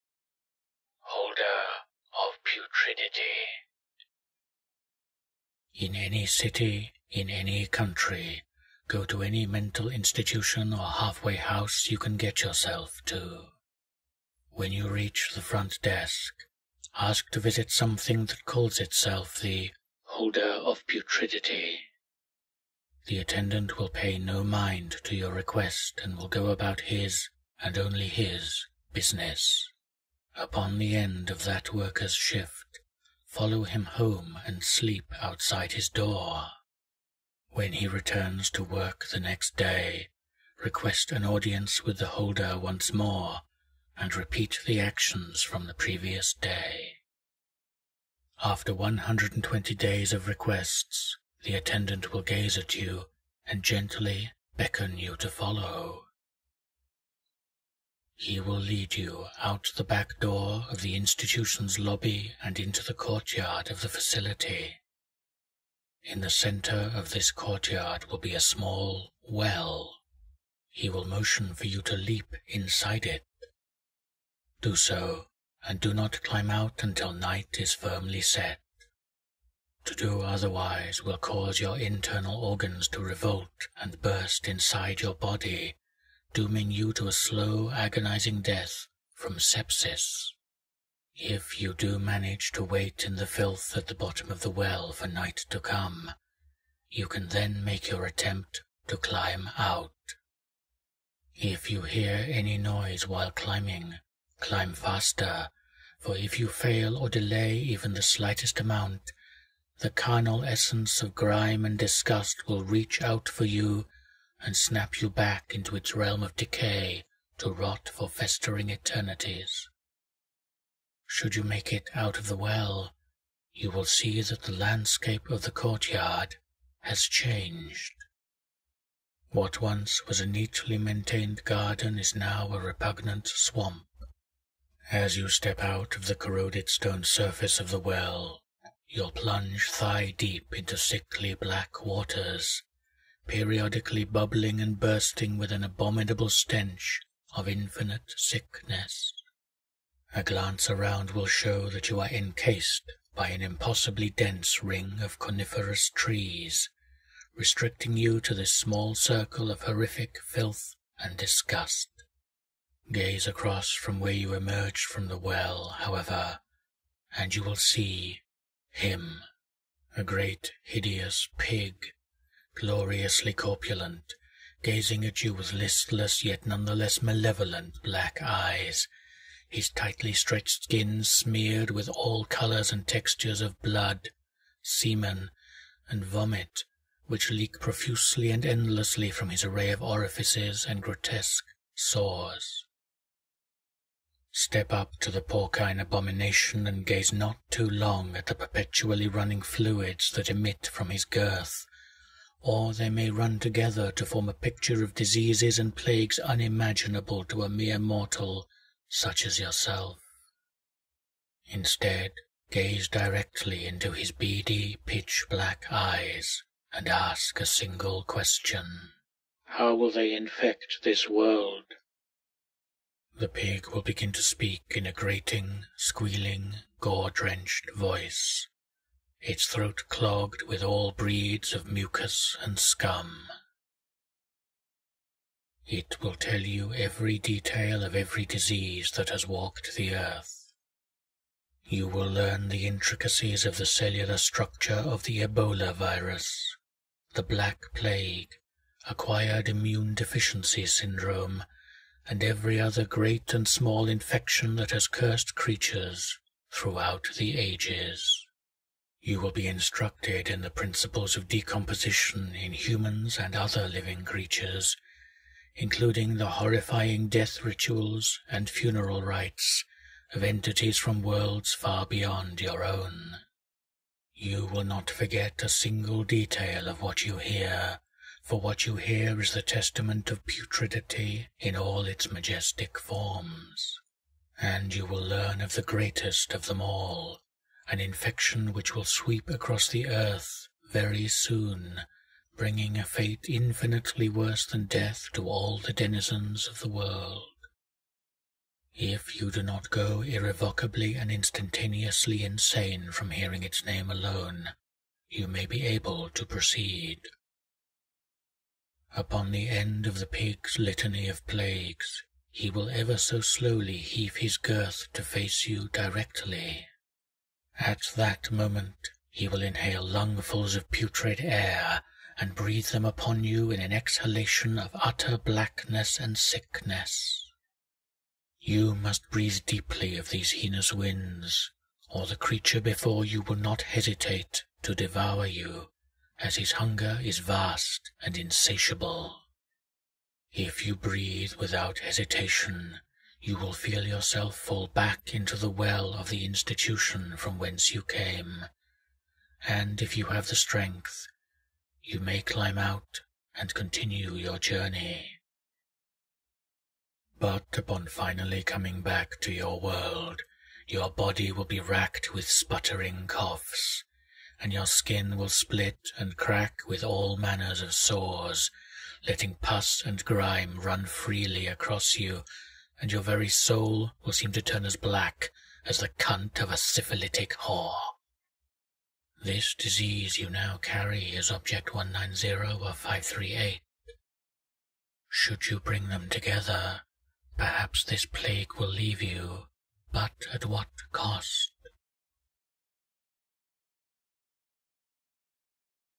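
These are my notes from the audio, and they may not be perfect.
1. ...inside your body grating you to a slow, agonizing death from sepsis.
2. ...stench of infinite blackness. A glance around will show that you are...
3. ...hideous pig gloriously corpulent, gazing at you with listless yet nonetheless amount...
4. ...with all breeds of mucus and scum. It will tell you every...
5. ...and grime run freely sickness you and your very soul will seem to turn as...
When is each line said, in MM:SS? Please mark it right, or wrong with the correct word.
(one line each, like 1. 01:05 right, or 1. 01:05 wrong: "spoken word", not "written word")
1. 01:24 wrong: "dooming", not "grating"
2. 02:26 wrong: "sickness", not "blackness"
3. 02:50 wrong: "malevolent", not "amount"
4. 03:50 right
5. 06:09 wrong: "across", not "sickness".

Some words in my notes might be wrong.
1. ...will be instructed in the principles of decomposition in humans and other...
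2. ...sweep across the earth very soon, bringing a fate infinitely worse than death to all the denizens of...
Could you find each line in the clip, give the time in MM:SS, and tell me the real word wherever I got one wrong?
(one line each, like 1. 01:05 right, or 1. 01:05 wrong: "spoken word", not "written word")
1. 04:19 right
2. 04:48 right.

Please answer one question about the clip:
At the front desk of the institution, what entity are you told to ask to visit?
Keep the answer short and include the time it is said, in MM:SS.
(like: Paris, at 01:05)
Holder of Putridity, at 00:20.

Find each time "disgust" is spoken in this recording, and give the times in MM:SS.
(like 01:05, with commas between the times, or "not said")
01:51, 02:41.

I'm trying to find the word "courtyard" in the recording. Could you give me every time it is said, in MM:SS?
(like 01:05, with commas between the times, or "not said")
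01:02, 01:07, 02:05.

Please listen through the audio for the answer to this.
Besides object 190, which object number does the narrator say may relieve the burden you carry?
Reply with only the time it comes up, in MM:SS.
06:22.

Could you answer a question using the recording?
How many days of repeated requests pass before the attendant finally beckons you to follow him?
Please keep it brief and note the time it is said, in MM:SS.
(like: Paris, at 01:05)
120, at 00:48.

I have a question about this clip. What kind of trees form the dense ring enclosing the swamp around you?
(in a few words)
Coniferous.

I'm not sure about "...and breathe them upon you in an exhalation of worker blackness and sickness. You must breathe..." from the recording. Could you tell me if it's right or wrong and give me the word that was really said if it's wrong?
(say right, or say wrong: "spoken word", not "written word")
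wrong: "utter", not "worker".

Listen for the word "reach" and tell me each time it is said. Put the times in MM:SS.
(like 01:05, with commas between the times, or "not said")
00:14, 01:52.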